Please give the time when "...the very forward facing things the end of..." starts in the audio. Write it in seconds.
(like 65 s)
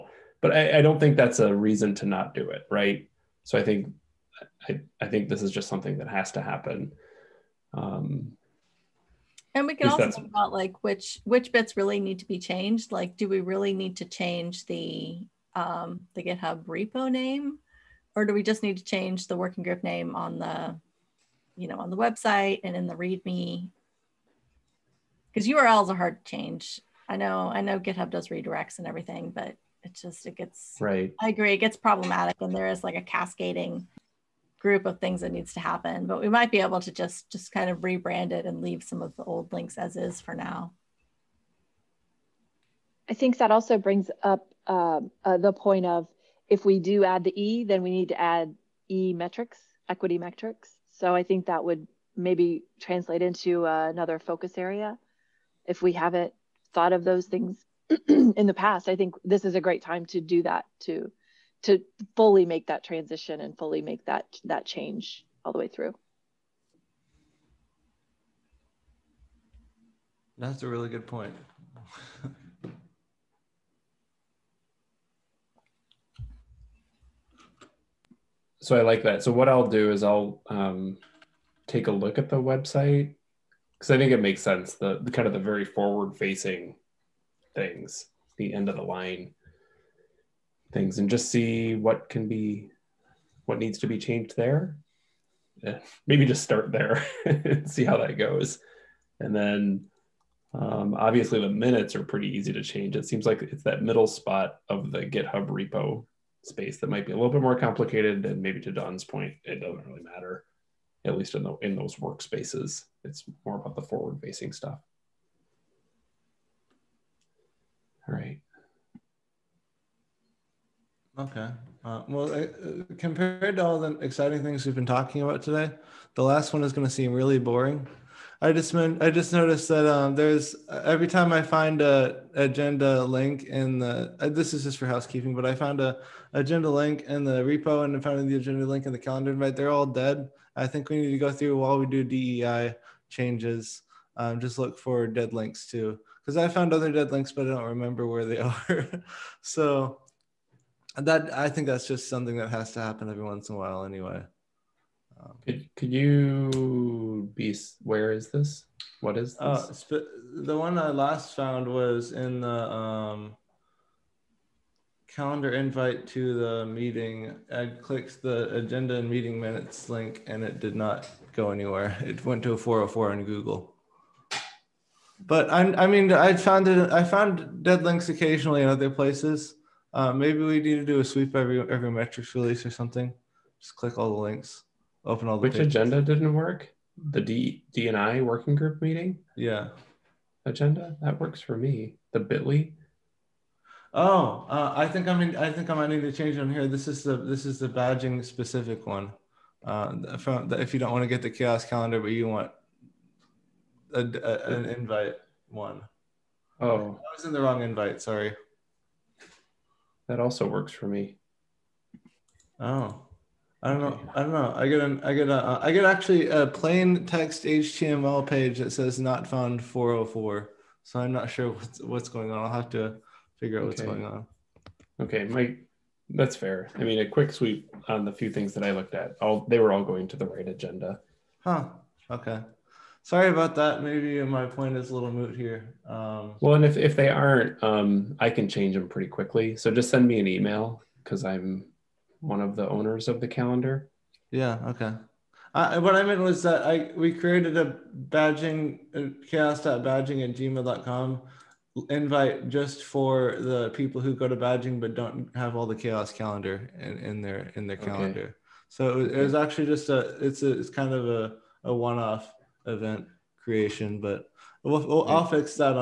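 85 s.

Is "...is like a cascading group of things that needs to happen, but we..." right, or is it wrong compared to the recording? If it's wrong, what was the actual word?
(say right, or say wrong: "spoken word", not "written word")
right.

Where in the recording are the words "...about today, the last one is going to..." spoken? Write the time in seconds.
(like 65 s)
125 s.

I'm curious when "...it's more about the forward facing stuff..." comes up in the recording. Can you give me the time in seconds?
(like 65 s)
113 s.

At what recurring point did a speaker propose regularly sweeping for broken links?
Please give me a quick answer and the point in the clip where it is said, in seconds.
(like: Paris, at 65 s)
every metrics release, at 181 s.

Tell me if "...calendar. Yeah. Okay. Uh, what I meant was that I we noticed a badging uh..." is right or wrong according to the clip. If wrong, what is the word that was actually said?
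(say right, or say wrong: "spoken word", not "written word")
wrong: "created", not "noticed".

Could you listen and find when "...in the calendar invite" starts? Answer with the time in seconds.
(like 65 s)
138 s.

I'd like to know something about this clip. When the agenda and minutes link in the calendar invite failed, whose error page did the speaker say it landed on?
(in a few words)
Google.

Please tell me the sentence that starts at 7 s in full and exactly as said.
Um, and we can also talk about like which which bits really need to be changed.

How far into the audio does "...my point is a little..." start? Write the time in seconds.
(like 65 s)
234 s.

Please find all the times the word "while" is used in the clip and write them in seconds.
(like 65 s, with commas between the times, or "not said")
141 s, 153 s.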